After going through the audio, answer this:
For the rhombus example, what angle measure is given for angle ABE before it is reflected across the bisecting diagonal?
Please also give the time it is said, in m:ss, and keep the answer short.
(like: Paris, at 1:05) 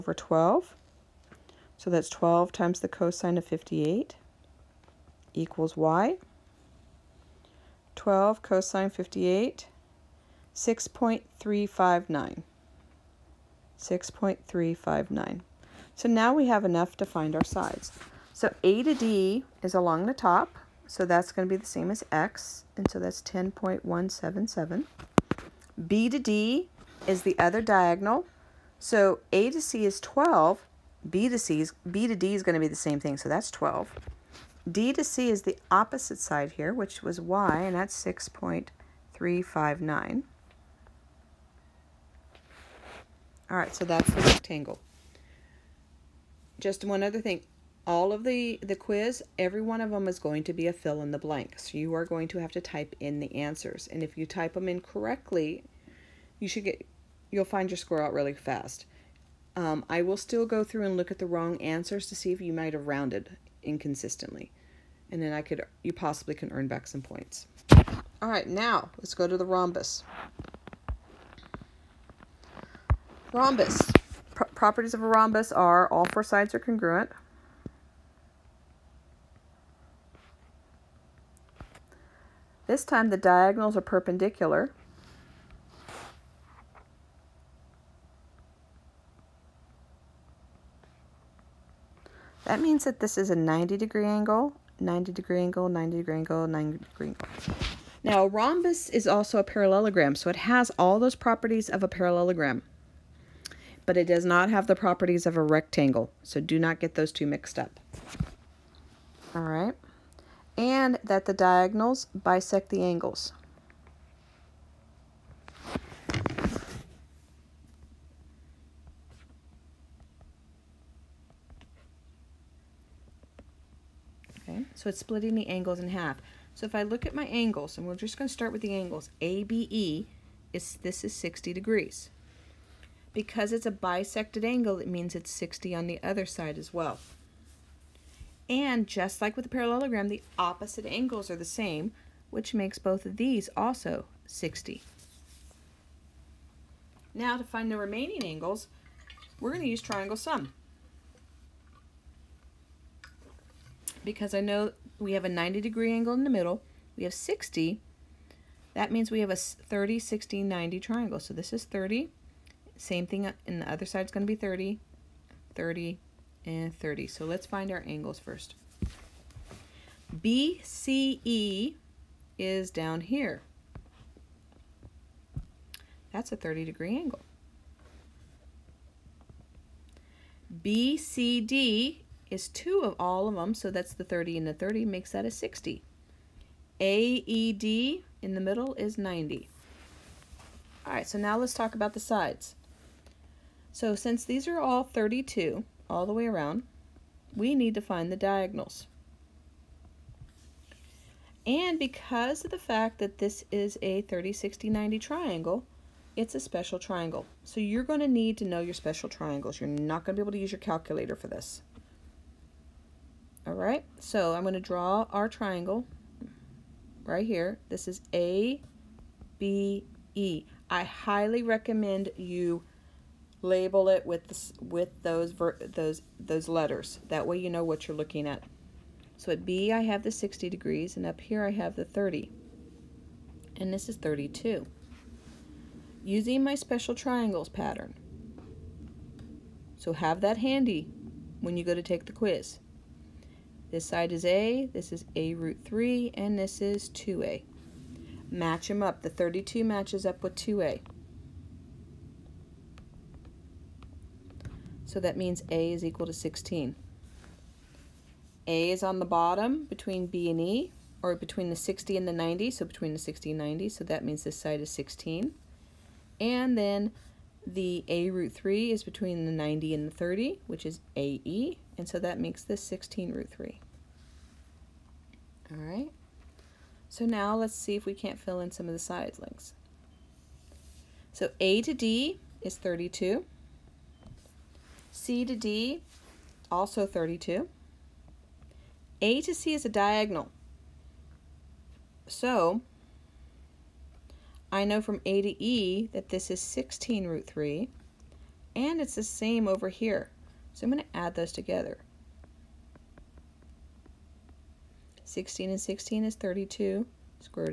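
60 degrees, at 2:10.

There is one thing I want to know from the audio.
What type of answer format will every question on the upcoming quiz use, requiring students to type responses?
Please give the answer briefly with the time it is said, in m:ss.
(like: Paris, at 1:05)
fill in the blank, at 0:50.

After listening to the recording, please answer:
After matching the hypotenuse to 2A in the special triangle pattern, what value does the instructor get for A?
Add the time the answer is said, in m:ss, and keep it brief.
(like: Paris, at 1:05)
16, at 4:15.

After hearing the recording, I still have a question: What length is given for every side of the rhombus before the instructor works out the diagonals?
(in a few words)
32.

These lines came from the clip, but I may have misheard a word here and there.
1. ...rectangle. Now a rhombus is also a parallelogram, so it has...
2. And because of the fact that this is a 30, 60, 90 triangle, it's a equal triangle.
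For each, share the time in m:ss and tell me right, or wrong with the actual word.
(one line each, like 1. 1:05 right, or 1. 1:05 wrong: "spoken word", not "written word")
1. 1:37 wrong: "angle", not "rectangle"
2. 3:21 wrong: "special", not "equal".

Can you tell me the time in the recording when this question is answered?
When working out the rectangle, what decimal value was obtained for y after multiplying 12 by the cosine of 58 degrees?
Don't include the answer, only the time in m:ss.
0:07.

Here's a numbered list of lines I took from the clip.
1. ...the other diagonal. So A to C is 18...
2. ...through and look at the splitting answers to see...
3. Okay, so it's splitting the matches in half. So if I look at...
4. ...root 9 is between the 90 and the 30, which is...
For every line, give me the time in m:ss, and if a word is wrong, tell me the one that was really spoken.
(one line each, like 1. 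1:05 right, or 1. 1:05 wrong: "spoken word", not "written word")
1. 0:27 wrong: "12", not "18"
2. 1:00 wrong: "wrong", not "splitting"
3. 2:04 wrong: "angles", not "matches"
4. 4:28 wrong: "3", not "9".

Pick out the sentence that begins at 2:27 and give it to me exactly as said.
Now to find the remaining angles, we're going to use triangle sum.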